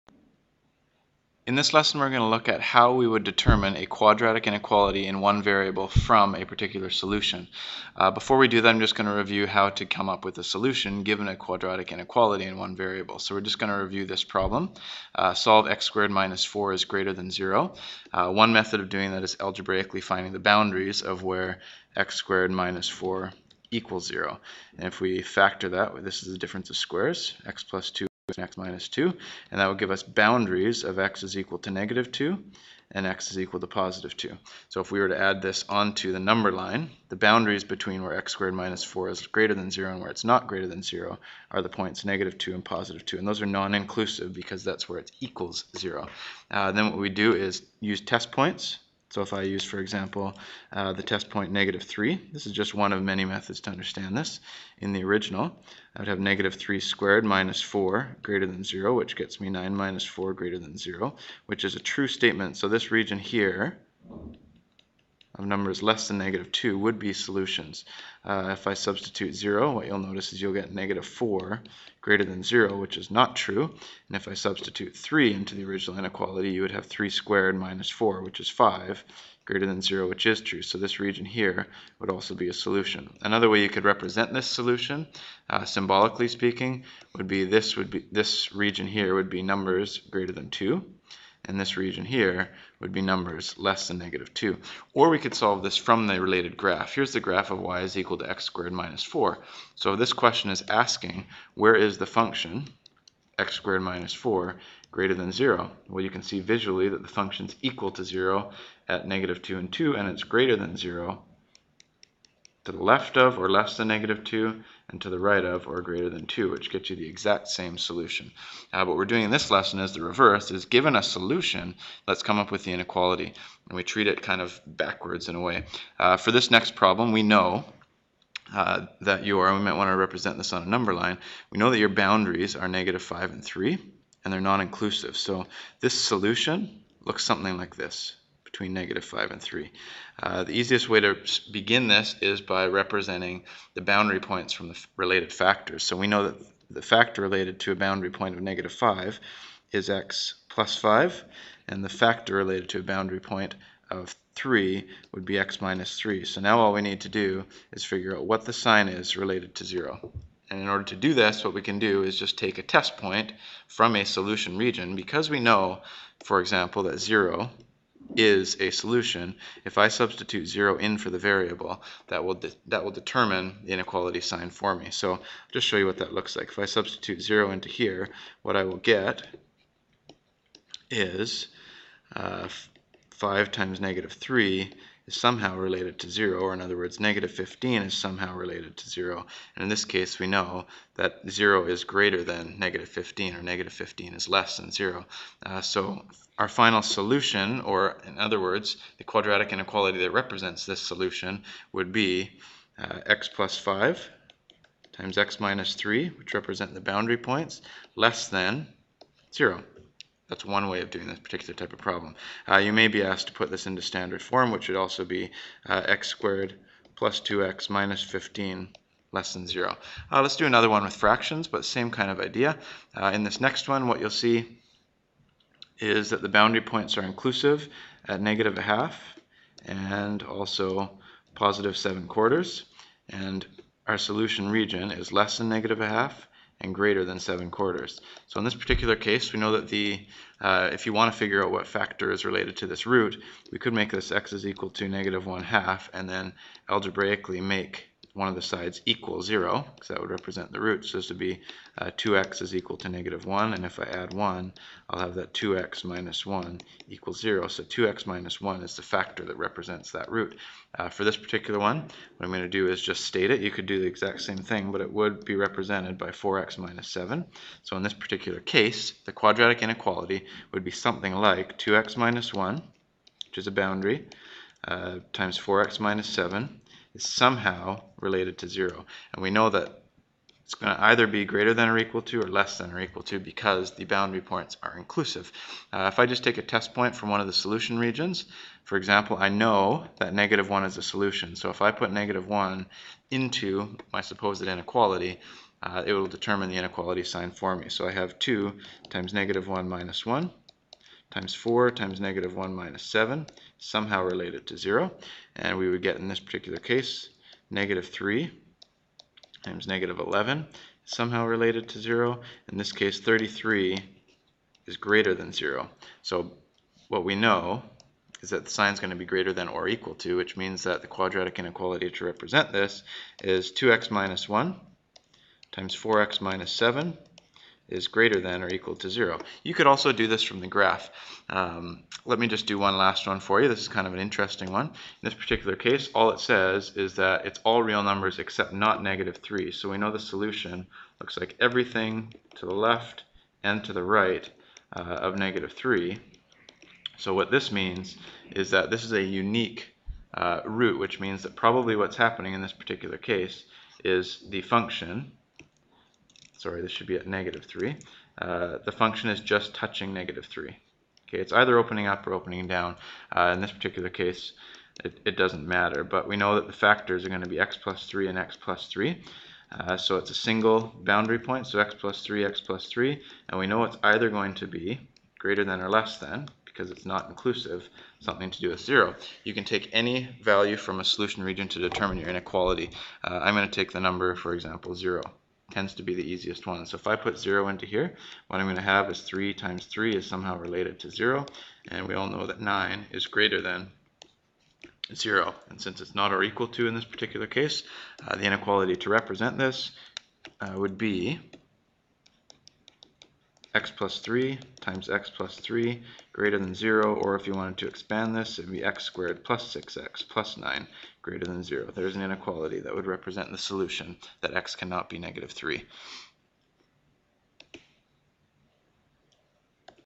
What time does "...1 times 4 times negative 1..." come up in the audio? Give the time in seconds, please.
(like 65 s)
300 s.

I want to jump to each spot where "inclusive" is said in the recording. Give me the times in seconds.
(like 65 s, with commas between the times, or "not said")
43 s, 134 s, 227 s, 284 s, 377 s.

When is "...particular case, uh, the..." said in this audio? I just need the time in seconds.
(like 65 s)
396 s.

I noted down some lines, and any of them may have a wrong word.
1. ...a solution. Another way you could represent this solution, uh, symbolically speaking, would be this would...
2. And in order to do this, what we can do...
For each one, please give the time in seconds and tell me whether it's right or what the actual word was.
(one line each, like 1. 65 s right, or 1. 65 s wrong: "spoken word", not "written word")
1. 82 s right
2. 160 s right.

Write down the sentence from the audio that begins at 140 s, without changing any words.
Uh, the easiest way to begin this is by representing the boundary points from the related factors.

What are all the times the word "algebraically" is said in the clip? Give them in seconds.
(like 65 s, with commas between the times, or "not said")
19 s, 246 s.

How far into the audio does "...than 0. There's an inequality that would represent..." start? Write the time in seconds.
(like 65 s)
411 s.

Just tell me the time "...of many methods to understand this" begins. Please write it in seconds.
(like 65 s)
52 s.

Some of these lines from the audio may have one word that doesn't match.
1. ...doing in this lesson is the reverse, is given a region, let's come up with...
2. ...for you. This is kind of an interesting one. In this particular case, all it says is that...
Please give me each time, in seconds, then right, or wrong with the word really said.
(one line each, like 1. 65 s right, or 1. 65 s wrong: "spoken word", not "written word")
1. 119 s wrong: "solution", not "region"
2. 333 s right.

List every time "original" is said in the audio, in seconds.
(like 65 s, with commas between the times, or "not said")
55 s, 75 s.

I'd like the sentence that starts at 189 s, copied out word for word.
And in this case, we know that 0 is greater than negative 15, or negative 15 is less than 0.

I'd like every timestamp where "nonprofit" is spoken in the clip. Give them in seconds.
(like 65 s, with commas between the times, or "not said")
not said.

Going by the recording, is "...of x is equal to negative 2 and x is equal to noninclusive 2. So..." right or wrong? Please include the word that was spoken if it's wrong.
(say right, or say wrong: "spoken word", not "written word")
wrong: "positive", not "noninclusive".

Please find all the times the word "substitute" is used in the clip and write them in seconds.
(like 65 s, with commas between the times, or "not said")
68 s, 74 s, 169 s, 176 s.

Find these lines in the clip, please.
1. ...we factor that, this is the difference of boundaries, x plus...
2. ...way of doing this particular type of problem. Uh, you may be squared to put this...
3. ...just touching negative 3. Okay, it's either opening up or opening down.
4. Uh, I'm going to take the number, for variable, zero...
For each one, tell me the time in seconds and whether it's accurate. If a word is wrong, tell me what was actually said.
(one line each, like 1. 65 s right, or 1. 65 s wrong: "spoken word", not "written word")
1. 25 s wrong: "squares", not "boundaries"
2. 210 s wrong: "asked", not "squared"
3. 359 s right
4. 383 s wrong: "example", not "variable".